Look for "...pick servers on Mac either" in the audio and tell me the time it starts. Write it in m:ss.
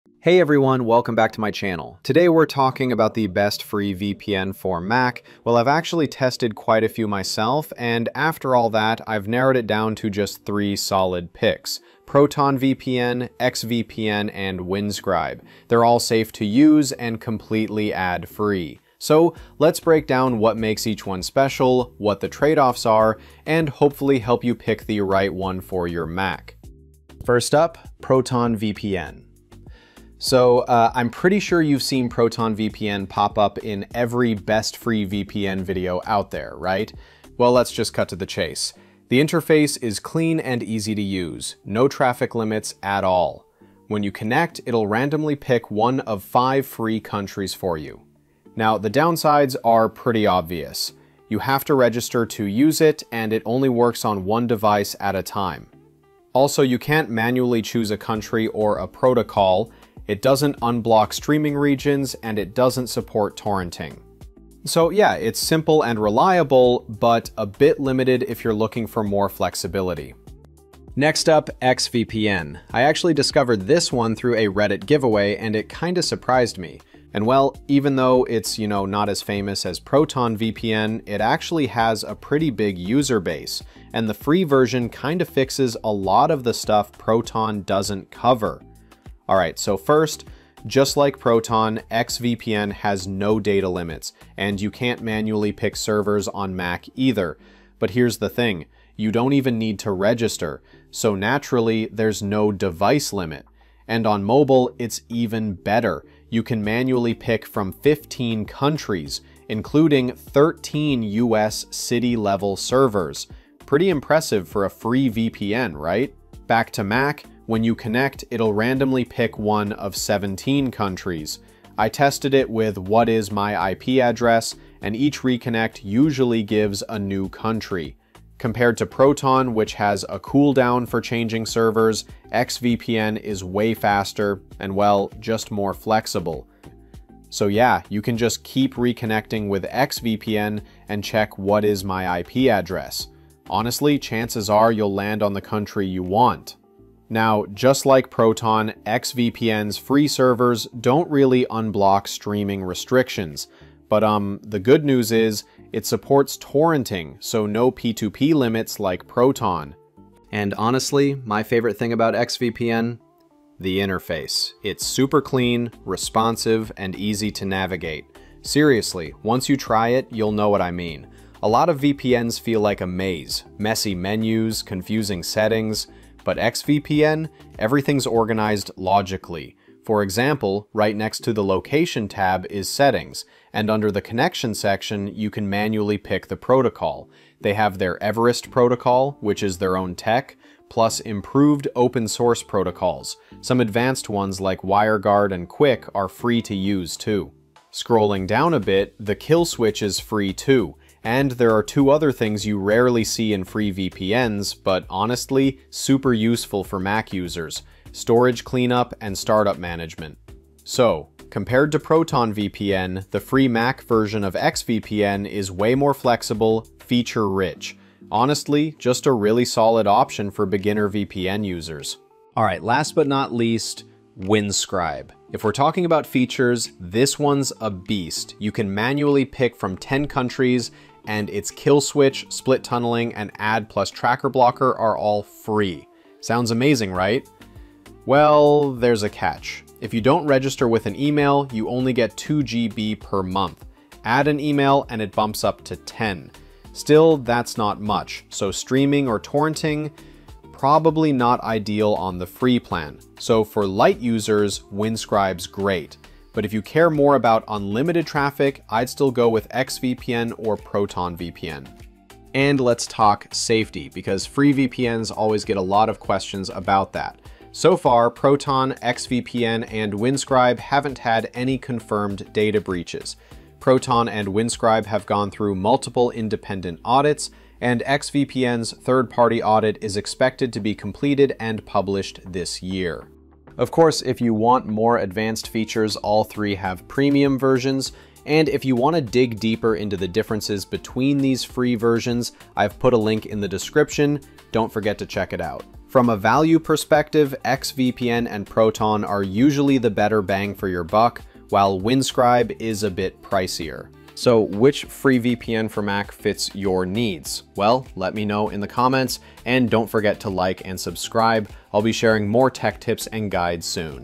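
1:35.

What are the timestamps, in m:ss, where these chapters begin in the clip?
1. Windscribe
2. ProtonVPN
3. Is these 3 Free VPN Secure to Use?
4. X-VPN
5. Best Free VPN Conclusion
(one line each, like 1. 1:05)
1. 3:42
2. 0:27
3. 4:23
4. 1:10
5. 4:44.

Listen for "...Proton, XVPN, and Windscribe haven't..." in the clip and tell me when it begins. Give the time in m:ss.
4:28.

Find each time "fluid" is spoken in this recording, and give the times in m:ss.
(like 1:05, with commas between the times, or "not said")
not said.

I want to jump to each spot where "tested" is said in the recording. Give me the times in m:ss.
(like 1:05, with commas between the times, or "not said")
0:06, 2:01.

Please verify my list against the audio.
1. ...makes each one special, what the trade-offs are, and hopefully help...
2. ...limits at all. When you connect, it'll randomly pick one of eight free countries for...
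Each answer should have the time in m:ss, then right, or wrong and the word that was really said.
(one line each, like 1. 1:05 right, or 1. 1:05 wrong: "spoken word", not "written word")
1. 0:20 right
2. 0:42 wrong: "five", not "eight".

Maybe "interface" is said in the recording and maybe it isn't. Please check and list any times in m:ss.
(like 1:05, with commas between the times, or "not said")
0:39, 2:43.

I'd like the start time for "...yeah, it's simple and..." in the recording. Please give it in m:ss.
1:04.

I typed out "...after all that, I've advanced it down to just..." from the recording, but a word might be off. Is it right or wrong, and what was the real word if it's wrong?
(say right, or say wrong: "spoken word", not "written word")
wrong: "narrowed", not "advanced".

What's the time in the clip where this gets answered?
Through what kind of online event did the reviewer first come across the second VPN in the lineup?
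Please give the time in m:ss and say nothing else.
1:14.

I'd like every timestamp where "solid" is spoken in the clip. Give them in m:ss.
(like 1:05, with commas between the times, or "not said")
0:10, 3:39.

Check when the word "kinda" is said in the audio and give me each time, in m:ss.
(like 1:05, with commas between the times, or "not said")
1:15, 1:24.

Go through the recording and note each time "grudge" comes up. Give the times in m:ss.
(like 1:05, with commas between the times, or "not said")
not said.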